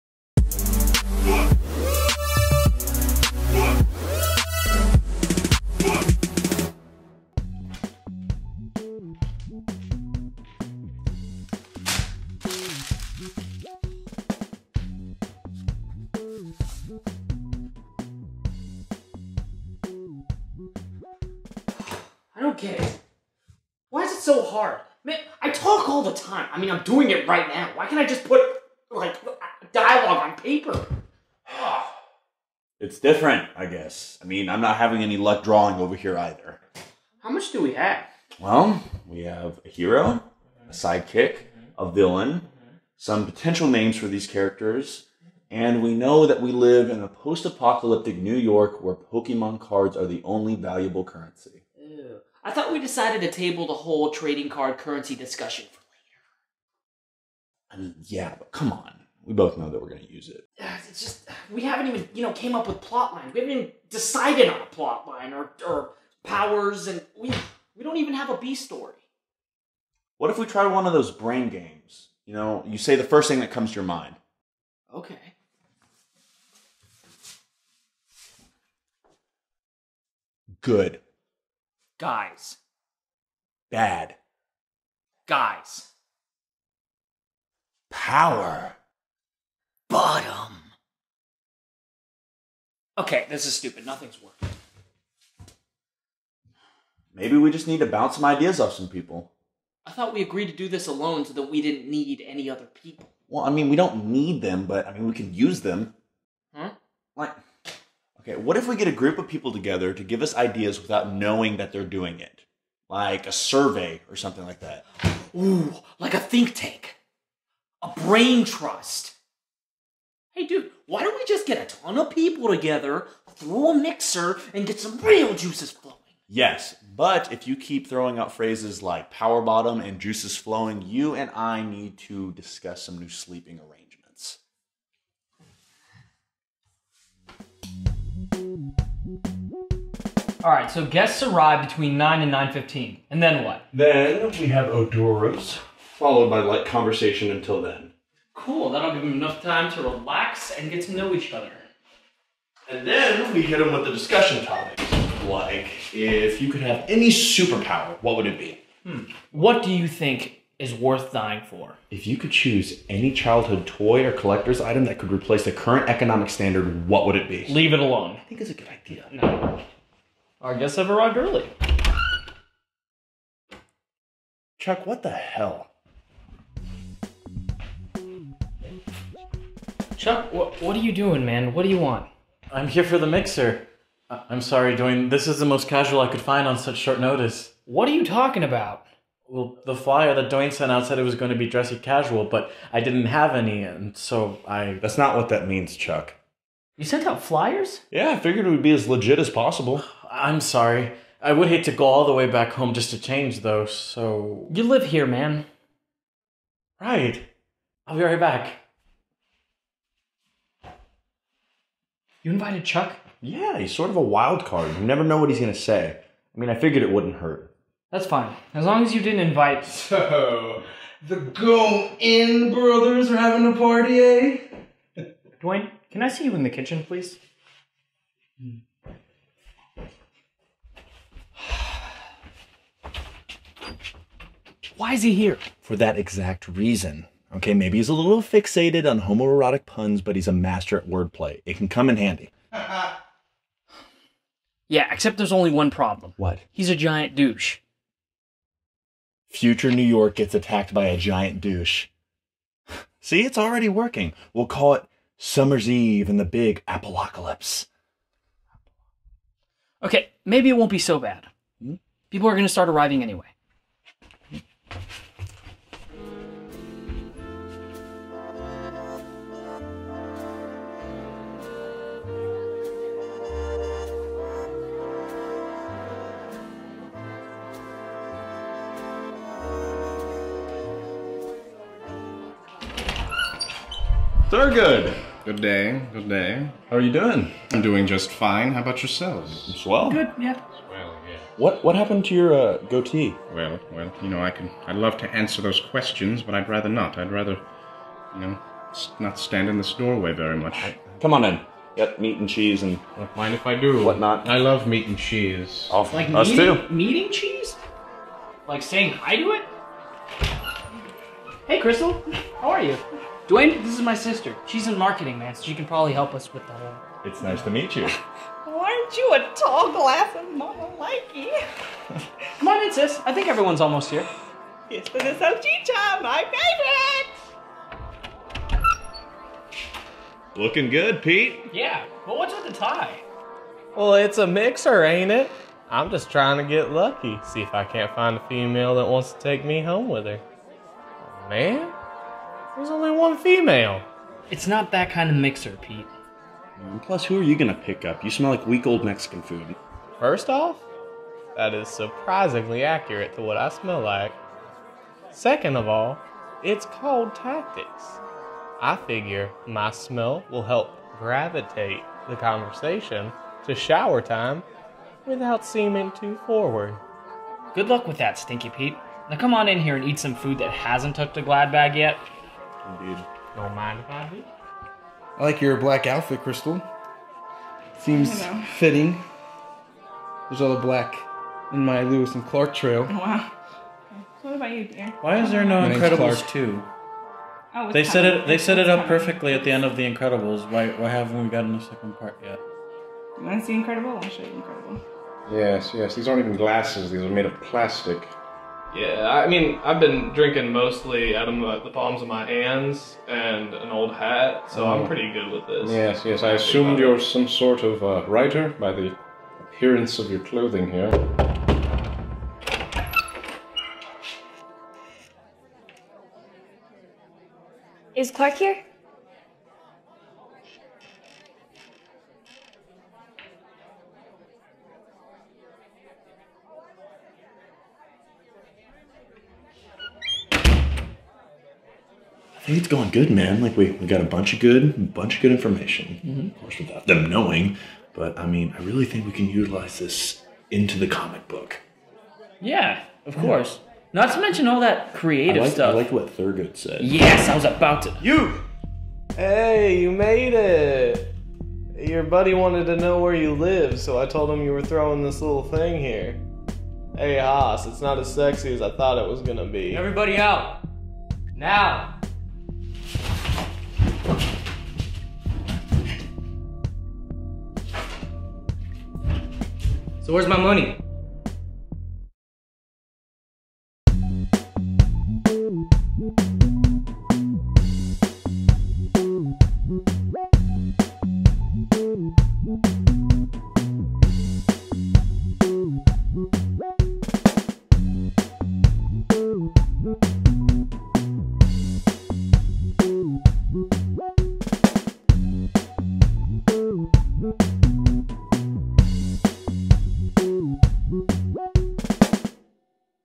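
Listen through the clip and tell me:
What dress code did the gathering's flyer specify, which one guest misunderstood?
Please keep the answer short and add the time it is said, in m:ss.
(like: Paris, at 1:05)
dressy casual, at 3:11.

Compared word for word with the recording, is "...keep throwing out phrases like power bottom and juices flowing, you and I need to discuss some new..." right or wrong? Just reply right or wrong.
right.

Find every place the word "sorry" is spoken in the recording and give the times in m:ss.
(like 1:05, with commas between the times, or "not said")
3:04, 3:20.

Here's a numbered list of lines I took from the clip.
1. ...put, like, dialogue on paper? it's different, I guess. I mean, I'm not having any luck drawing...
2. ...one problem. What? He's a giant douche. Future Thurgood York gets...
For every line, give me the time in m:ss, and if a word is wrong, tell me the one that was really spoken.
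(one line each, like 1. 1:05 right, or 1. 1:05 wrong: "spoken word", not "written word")
1. 0:28 right
2. 4:05 wrong: "New", not "Thurgood".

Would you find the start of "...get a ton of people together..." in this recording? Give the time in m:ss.
2:01.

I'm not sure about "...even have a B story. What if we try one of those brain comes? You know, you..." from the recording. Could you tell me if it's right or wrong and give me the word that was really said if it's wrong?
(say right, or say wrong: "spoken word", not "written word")
wrong: "games", not "comes".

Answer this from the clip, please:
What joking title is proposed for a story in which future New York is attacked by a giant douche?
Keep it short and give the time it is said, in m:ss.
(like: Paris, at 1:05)
Summer's Eve and the Big Apocalypse, at 4:15.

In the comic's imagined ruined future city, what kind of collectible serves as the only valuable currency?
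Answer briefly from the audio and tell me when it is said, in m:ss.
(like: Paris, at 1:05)
Pokemon cards, at 0:48.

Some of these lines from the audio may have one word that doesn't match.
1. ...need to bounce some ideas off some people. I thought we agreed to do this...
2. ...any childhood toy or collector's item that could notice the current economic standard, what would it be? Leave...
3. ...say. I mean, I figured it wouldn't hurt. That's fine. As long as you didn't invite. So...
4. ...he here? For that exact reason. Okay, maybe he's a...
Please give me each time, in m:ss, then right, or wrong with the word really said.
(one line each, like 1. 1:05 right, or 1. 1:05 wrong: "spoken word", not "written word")
1. 1:37 right
2. 2:42 wrong: "replace", not "notice"
3. 3:35 right
4. 3:55 right.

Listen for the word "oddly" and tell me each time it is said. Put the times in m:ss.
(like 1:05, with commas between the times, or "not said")
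not said.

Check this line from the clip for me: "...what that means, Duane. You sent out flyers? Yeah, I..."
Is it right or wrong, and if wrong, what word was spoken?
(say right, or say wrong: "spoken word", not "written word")
wrong: "Chuck", not "Duane".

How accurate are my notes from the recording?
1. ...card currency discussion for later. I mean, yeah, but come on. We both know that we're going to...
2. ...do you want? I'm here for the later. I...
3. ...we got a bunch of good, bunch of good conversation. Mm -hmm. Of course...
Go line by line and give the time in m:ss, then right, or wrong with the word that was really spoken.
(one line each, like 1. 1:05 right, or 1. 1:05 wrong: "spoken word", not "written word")
1. 0:54 right
2. 3:01 wrong: "mixer", not "later"
3. 7:13 wrong: "information", not "conversation".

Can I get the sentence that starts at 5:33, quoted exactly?
Well, it's a mixer, ain't it?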